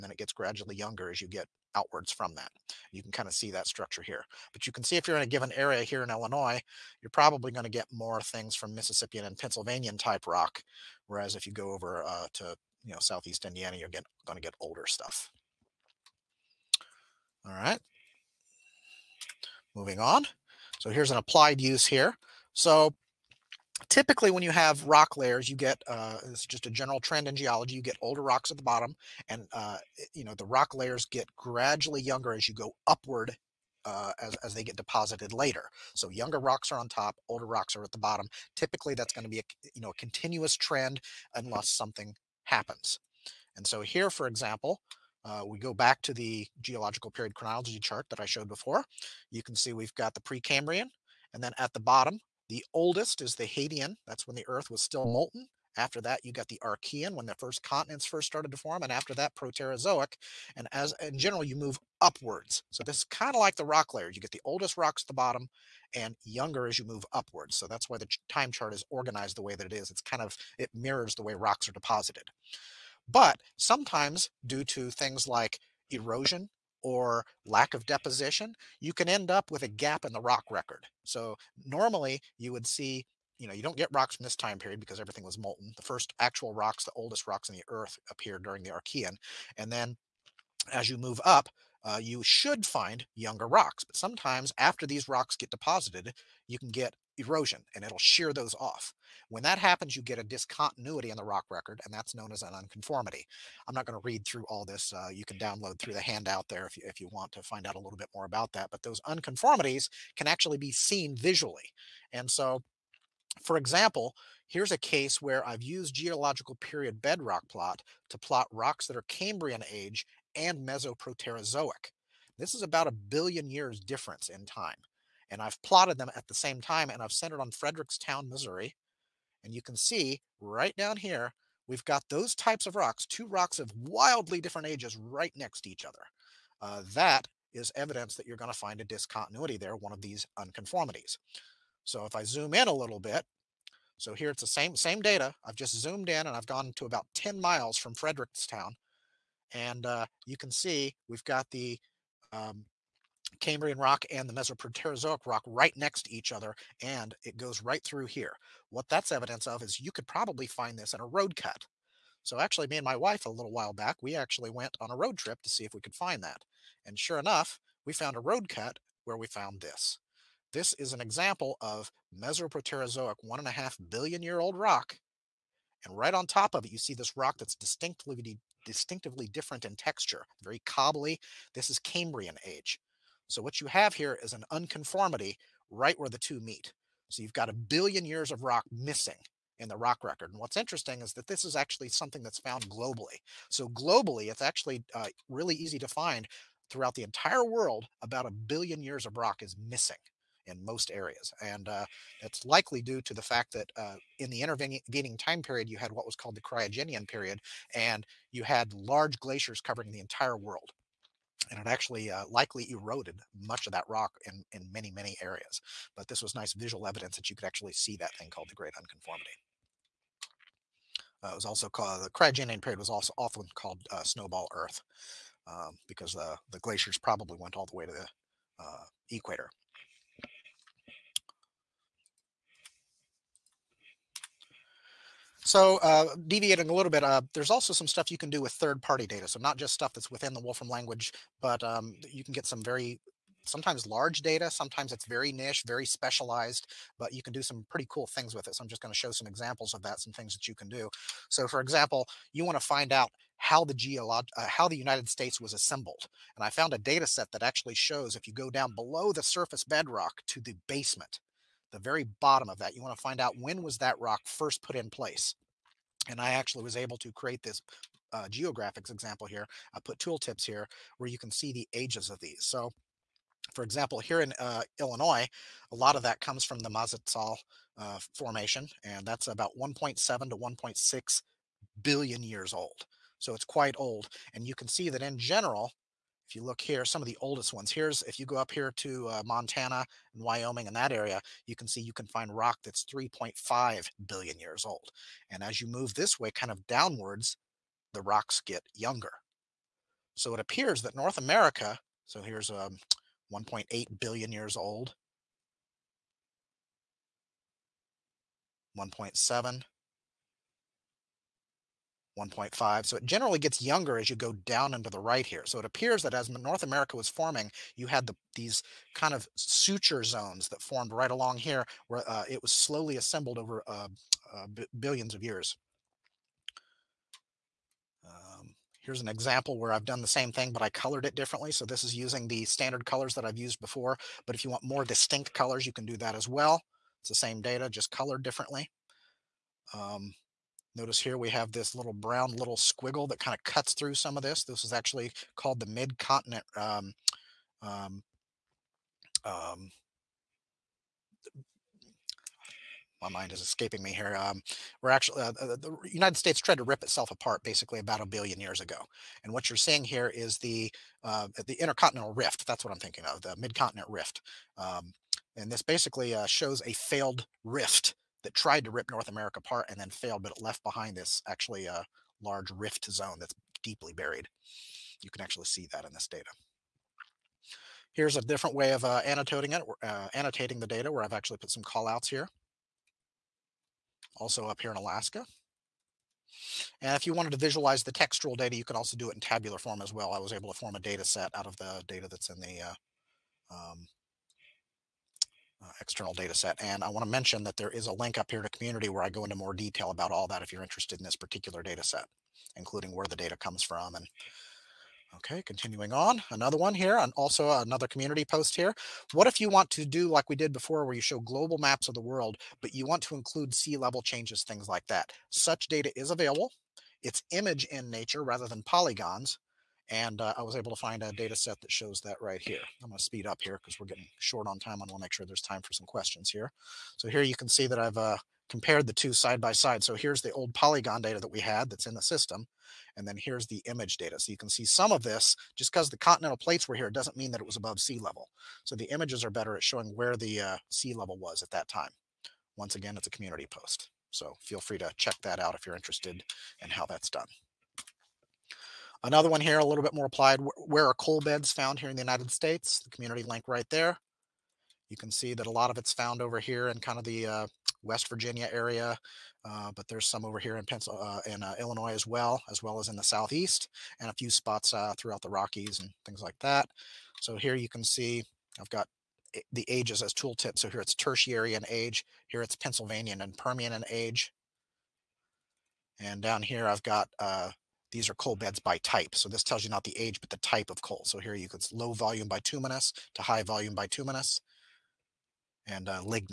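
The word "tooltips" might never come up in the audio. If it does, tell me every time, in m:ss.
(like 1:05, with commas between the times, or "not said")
4:29, 7:50.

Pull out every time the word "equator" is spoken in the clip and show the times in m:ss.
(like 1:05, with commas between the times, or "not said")
3:49.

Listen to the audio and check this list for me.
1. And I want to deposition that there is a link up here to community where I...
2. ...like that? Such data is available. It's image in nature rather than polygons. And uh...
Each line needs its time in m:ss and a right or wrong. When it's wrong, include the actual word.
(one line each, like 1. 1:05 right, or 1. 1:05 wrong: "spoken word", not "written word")
1. 6:36 wrong: "mention", not "deposition"
2. 6:54 right.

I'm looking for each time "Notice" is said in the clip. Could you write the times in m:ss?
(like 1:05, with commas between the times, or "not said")
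5:40.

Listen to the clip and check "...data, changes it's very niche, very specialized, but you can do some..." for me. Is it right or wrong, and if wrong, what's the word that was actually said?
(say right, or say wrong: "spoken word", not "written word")
wrong: "sometimes", not "changes".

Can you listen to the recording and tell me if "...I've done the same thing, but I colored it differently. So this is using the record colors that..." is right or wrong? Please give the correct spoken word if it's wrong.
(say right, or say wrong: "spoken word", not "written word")
wrong: "standard", not "record".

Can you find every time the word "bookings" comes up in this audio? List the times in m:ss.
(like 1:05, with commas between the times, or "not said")
not said.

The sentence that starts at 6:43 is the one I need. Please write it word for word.
And okay, continuing on, another one here, and also another community post here.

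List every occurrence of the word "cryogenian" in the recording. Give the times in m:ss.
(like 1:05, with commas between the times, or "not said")
3:26, 3:42.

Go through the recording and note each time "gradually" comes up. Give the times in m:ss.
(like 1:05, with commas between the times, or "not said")
0:00, 0:31.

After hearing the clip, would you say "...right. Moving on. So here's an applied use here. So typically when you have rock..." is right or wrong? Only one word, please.
right.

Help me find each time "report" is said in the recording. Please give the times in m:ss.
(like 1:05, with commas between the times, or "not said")
not said.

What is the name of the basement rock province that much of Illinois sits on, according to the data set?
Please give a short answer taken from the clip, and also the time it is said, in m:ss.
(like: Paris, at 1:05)
Mazatzal, at 4:36.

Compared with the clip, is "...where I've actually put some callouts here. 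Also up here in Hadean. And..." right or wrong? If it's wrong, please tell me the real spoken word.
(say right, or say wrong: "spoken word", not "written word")
wrong: "Alaska", not "Hadean".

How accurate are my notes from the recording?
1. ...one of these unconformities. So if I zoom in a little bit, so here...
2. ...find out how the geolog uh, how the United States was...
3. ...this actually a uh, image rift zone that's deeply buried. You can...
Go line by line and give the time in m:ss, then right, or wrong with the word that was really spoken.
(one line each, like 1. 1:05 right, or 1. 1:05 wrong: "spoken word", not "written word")
1. 2:19 right
2. 4:12 right
3. 6:10 wrong: "large", not "image".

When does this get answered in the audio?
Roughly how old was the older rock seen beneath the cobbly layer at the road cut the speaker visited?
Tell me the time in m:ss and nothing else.
2:53.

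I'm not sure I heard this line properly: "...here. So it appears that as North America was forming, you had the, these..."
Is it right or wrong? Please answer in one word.
right.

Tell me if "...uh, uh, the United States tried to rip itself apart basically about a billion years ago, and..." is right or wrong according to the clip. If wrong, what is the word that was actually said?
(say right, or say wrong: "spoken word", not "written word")
right.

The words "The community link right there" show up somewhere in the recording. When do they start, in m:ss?
7:32.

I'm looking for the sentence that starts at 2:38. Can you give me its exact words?
What that's evidence of is you could probably find this in a road cut.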